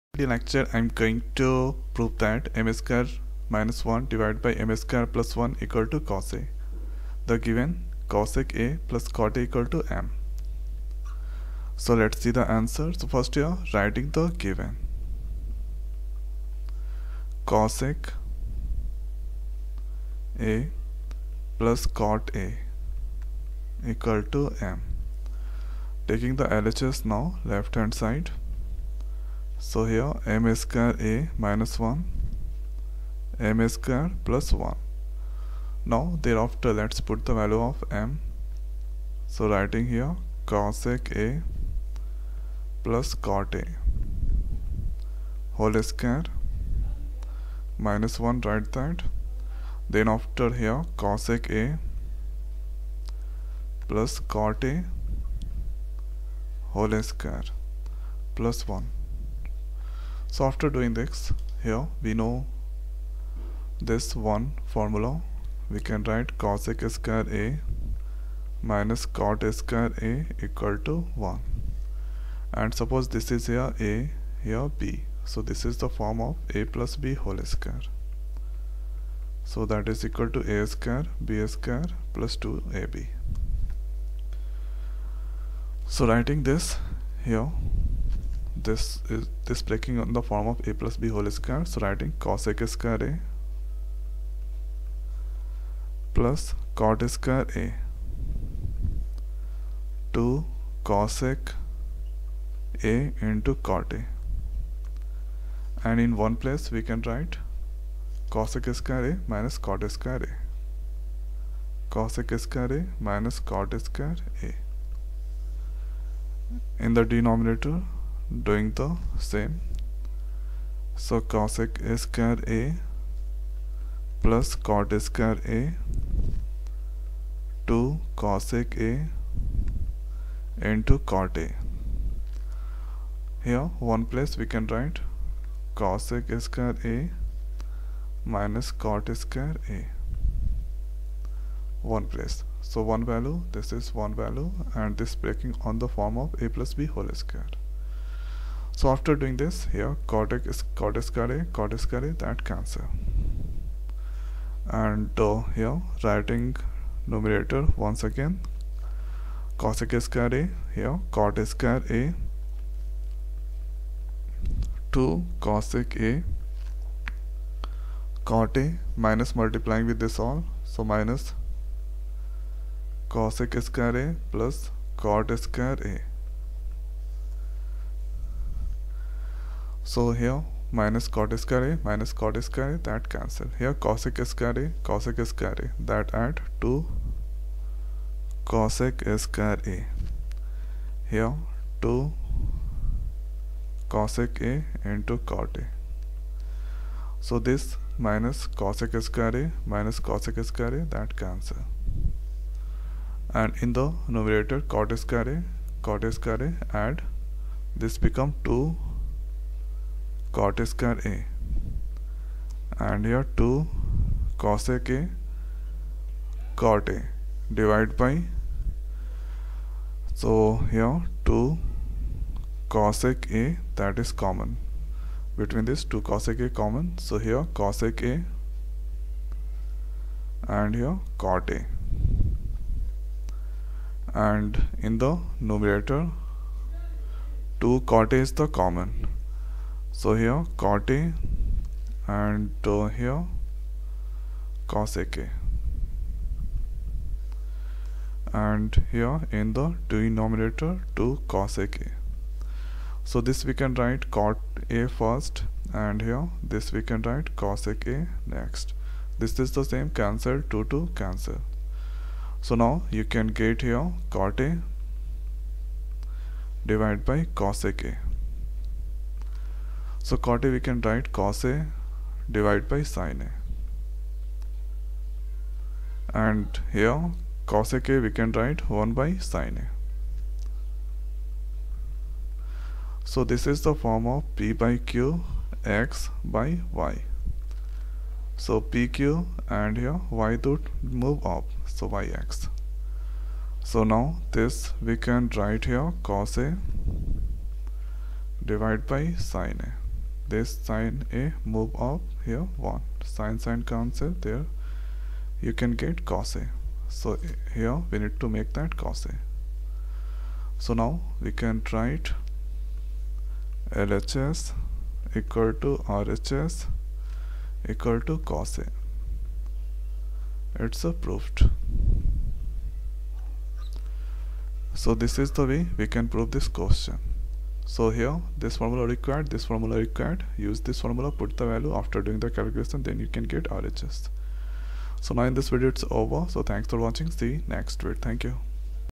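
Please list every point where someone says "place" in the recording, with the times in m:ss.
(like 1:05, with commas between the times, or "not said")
1:46, 2:14, 2:22.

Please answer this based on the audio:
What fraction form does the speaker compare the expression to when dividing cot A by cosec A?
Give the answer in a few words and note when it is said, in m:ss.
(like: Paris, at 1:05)
P by Q x by y, at 4:44.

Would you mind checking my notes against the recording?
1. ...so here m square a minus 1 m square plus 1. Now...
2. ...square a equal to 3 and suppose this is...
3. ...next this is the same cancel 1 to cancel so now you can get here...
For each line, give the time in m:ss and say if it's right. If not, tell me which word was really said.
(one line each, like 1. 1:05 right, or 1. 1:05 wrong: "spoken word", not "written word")
1. 0:29 right
2. 1:09 wrong: "1", not "3"
3. 4:18 wrong: "2", not "1".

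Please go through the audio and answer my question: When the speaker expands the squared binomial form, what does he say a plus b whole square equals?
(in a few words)
a² + b² + 2ab.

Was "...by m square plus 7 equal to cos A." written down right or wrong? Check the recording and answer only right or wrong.
wrong.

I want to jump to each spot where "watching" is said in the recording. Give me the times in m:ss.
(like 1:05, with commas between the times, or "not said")
5:36.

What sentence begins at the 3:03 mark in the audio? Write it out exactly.
Here cosec square carry, cosec square carry, that add to cosec square.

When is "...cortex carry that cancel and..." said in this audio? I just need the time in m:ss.
2:31.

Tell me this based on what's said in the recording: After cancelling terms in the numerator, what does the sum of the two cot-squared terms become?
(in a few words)
2 cot² A.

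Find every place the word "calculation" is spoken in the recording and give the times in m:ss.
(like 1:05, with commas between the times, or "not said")
5:32.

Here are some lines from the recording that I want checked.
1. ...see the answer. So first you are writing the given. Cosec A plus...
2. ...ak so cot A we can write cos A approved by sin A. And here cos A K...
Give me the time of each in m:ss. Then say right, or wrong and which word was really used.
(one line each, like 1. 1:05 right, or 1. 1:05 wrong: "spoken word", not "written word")
1. 0:12 right
2. 4:27 wrong: "divided", not "approved".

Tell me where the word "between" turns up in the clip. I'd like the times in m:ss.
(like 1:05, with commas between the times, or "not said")
3:45.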